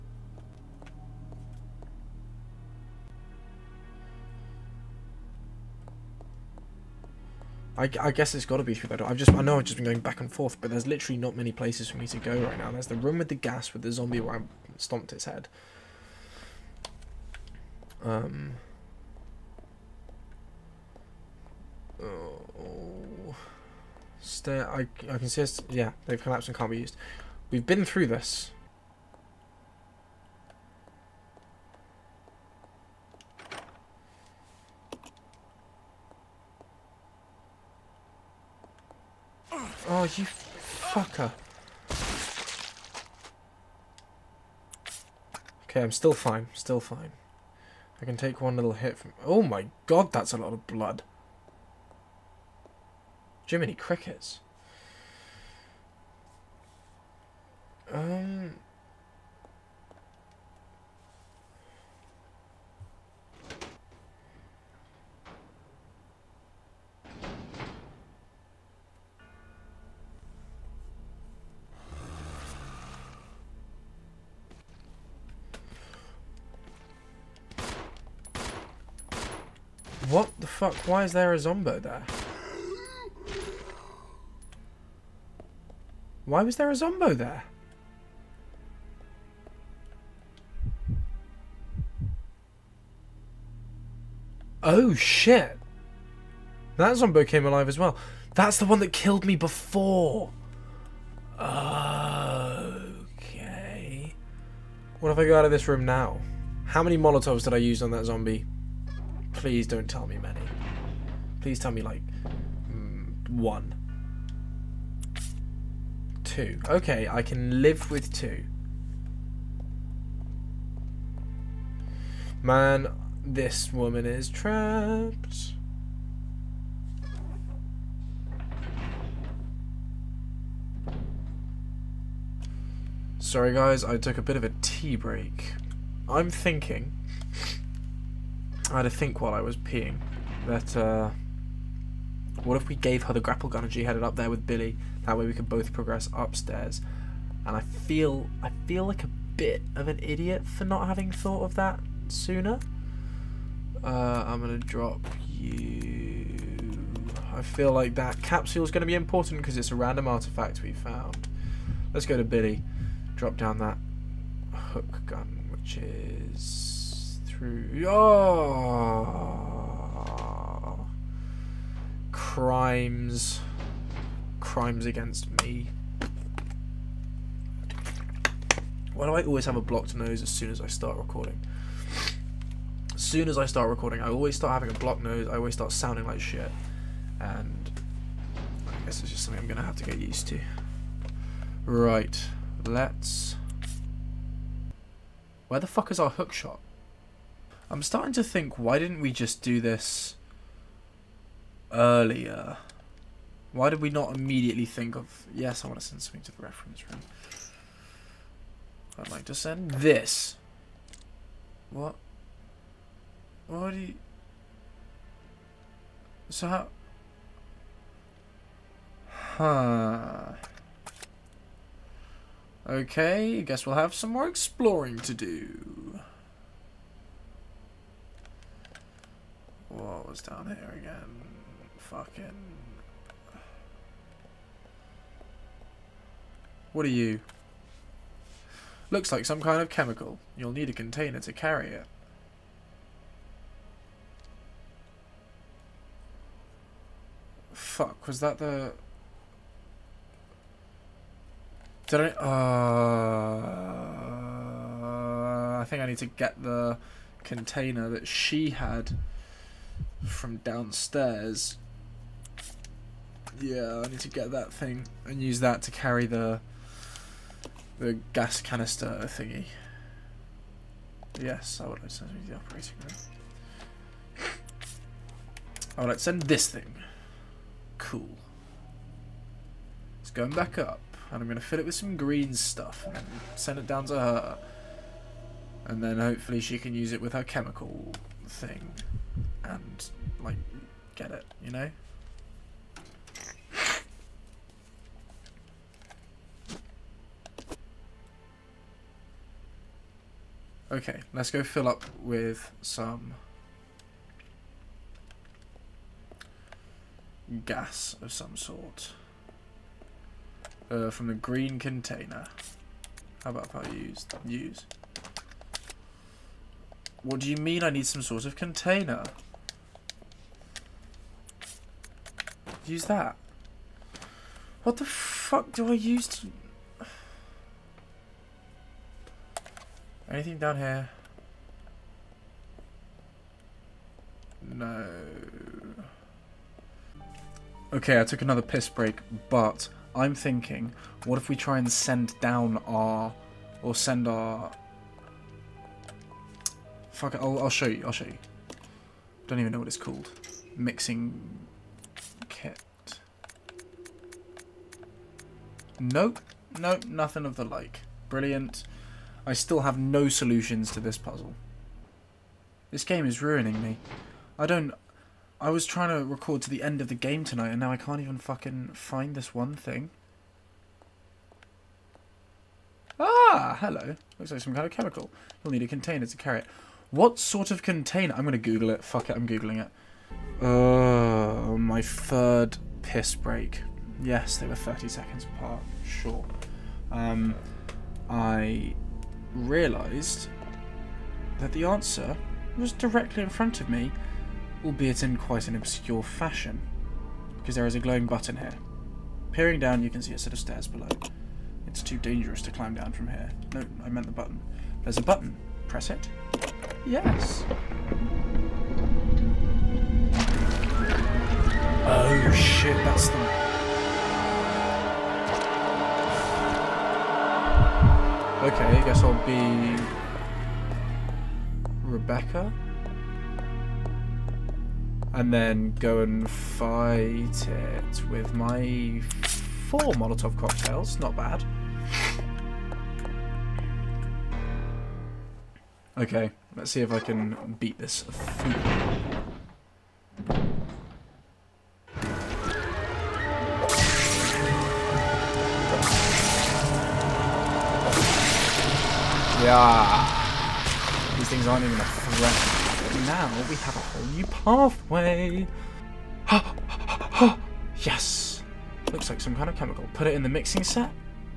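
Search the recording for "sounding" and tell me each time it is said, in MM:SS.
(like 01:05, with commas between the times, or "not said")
03:05.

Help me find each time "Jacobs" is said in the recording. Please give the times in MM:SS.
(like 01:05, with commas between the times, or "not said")
not said.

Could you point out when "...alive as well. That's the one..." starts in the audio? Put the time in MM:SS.
01:37.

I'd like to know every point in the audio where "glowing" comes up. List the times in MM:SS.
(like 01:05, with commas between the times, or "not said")
06:37.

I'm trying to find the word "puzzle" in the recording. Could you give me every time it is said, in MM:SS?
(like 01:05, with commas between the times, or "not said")
06:00.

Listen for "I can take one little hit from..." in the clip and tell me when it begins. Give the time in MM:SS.
00:48.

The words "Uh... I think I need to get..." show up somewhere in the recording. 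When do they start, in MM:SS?
04:12.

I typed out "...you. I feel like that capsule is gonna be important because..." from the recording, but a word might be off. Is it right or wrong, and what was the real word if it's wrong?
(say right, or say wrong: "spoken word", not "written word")
right.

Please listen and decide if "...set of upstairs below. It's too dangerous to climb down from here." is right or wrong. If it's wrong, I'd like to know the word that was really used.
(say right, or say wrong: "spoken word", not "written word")
wrong: "stairs", not "upstairs".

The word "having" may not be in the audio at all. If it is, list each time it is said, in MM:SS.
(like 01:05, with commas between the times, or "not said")
02:30, 03:04.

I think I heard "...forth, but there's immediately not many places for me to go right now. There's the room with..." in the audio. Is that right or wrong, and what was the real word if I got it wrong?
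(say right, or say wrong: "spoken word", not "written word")
wrong: "literally", not "immediately".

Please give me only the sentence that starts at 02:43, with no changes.
Drop down that hook gun, which is True.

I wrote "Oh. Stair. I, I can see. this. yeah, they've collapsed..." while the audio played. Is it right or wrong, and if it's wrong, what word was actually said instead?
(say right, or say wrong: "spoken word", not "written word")
right.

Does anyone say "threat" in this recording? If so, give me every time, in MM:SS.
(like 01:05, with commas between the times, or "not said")
07:31.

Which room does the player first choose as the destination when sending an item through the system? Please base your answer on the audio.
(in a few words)
reference room.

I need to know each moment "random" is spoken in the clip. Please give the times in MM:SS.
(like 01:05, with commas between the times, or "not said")
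02:39.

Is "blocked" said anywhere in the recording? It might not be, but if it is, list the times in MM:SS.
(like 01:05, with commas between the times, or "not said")
02:59, 03:04.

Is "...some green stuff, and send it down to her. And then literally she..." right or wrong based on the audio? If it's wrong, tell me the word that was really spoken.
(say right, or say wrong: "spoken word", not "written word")
wrong: "hopefully", not "literally".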